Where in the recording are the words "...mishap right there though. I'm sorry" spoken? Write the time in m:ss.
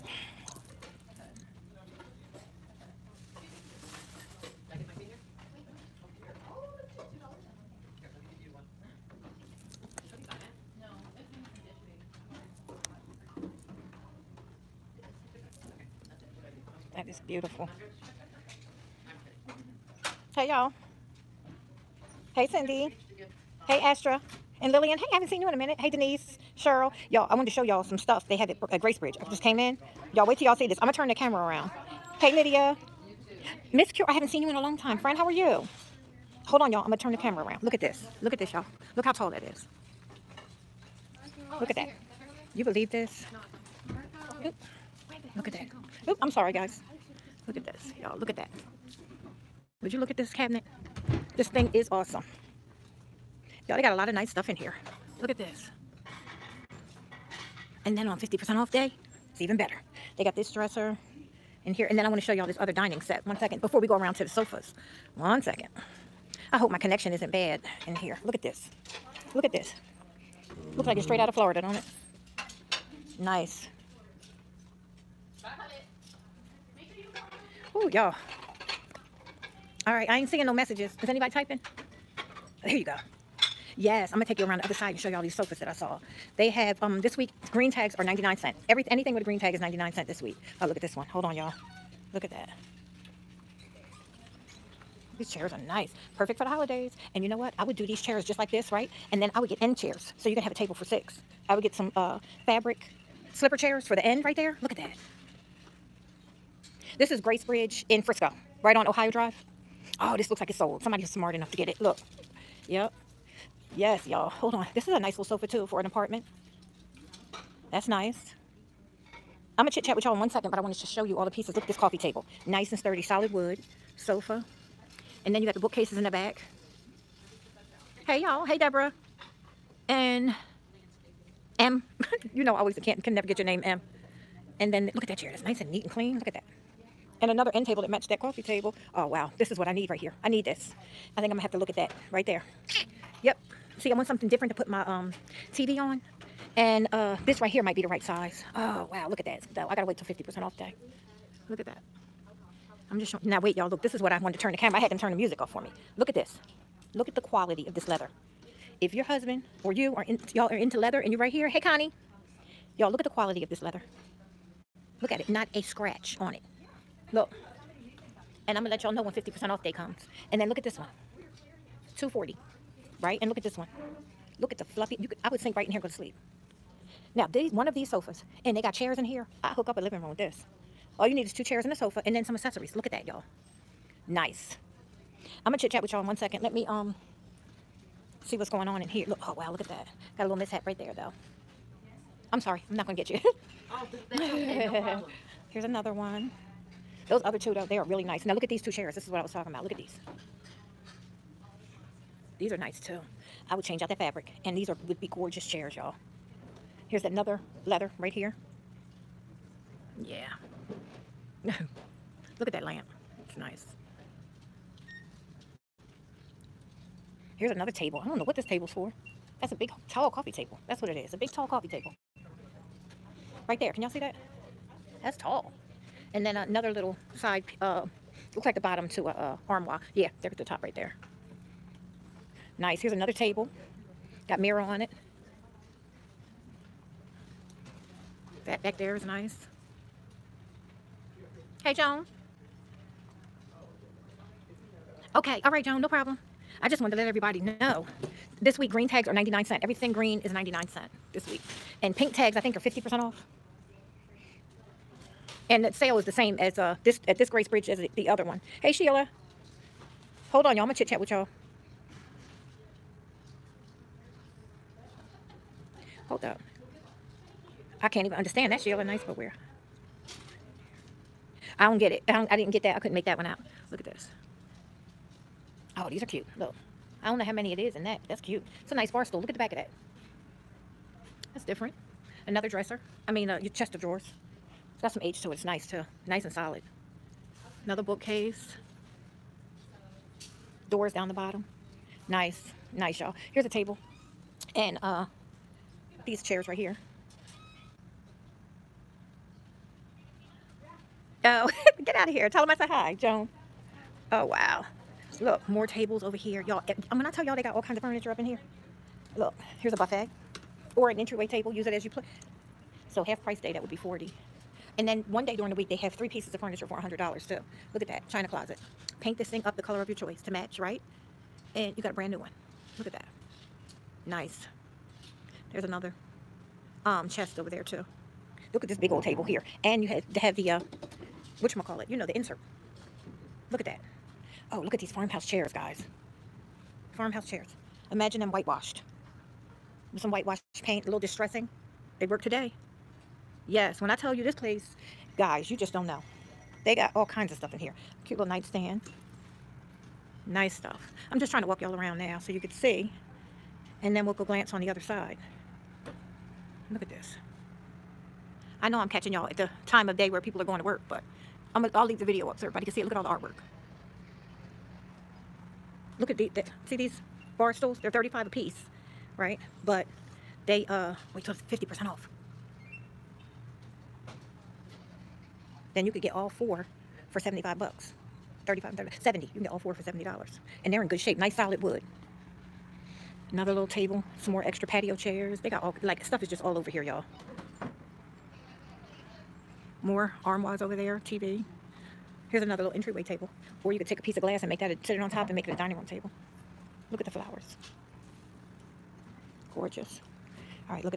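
3:10.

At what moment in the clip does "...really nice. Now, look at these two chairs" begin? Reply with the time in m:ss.
3:17.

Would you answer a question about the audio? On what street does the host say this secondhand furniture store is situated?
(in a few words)
Ohio Drive.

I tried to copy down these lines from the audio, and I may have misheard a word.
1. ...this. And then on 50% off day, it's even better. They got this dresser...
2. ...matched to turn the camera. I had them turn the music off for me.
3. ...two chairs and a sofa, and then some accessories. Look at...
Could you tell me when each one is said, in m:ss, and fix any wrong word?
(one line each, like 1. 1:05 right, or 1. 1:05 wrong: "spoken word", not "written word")
1. 0:55 right
2. 2:34 wrong: "wanted", not "matched"
3. 3:01 right.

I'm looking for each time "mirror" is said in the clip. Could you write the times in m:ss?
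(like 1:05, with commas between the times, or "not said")
3:54.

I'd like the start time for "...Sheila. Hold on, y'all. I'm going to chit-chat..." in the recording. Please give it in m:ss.
4:18.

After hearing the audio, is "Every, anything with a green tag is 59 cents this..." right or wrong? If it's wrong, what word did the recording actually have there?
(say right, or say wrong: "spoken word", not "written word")
wrong: "99", not "59".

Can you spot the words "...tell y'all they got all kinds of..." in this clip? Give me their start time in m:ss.
5:07.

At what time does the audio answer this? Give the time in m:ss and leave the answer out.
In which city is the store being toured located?
1:48.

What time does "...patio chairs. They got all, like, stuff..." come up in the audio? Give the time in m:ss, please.
6:24.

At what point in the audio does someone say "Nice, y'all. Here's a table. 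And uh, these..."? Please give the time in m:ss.
4:52.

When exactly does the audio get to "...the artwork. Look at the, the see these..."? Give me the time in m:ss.
6:03.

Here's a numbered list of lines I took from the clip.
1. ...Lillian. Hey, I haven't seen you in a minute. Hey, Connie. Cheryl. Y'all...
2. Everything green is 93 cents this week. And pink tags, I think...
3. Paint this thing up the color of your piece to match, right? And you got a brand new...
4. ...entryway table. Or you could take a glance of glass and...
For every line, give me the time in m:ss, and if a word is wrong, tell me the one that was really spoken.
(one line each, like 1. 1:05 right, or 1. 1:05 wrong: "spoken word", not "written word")
1. 0:24 wrong: "Denise", not "Connie"
2. 4:09 wrong: "99", not "93"
3. 5:18 wrong: "choice", not "piece"
4. 6:32 wrong: "piece", not "glance".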